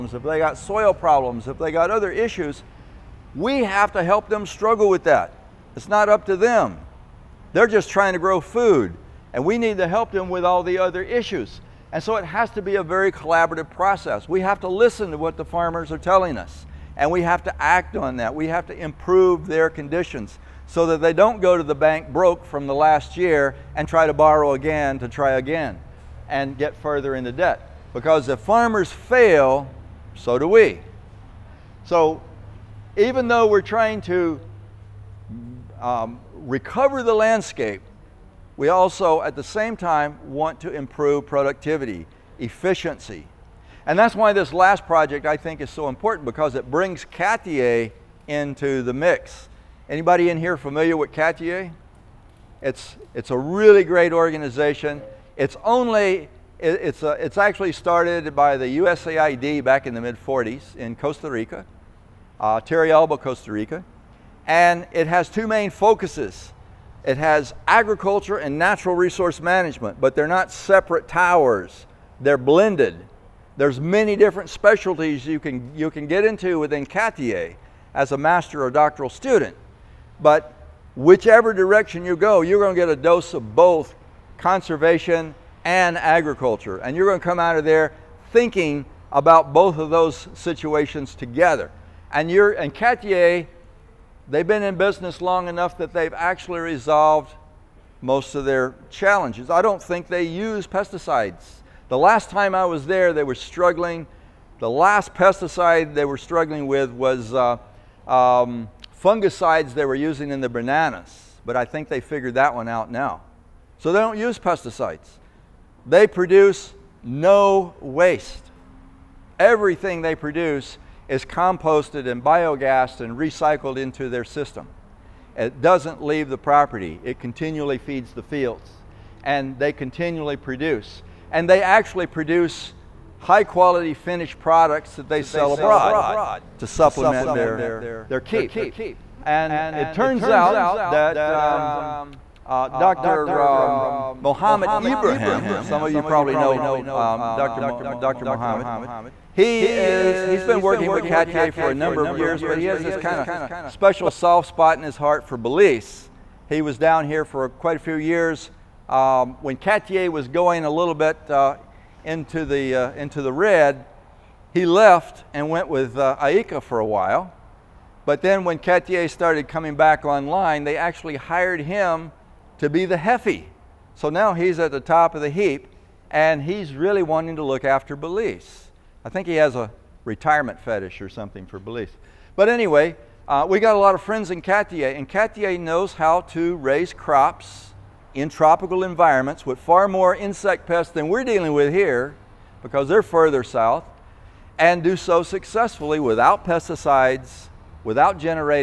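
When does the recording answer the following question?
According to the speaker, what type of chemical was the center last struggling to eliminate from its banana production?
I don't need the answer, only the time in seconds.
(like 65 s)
109 s.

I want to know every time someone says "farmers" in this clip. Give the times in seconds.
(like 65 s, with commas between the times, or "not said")
15 s, 28 s.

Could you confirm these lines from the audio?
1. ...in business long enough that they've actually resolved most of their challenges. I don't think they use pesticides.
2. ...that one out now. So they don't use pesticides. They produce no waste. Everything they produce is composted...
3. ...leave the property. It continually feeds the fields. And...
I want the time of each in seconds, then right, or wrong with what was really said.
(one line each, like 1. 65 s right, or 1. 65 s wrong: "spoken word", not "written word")
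1. 94 s right
2. 112 s right
3. 126 s right.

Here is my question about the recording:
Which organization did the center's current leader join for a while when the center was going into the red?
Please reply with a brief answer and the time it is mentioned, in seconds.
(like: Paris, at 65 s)
IICA, at 166 s.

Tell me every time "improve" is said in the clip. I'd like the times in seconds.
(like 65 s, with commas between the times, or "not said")
18 s, 40 s.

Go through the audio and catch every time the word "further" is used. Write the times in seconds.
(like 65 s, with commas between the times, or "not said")
26 s, 193 s.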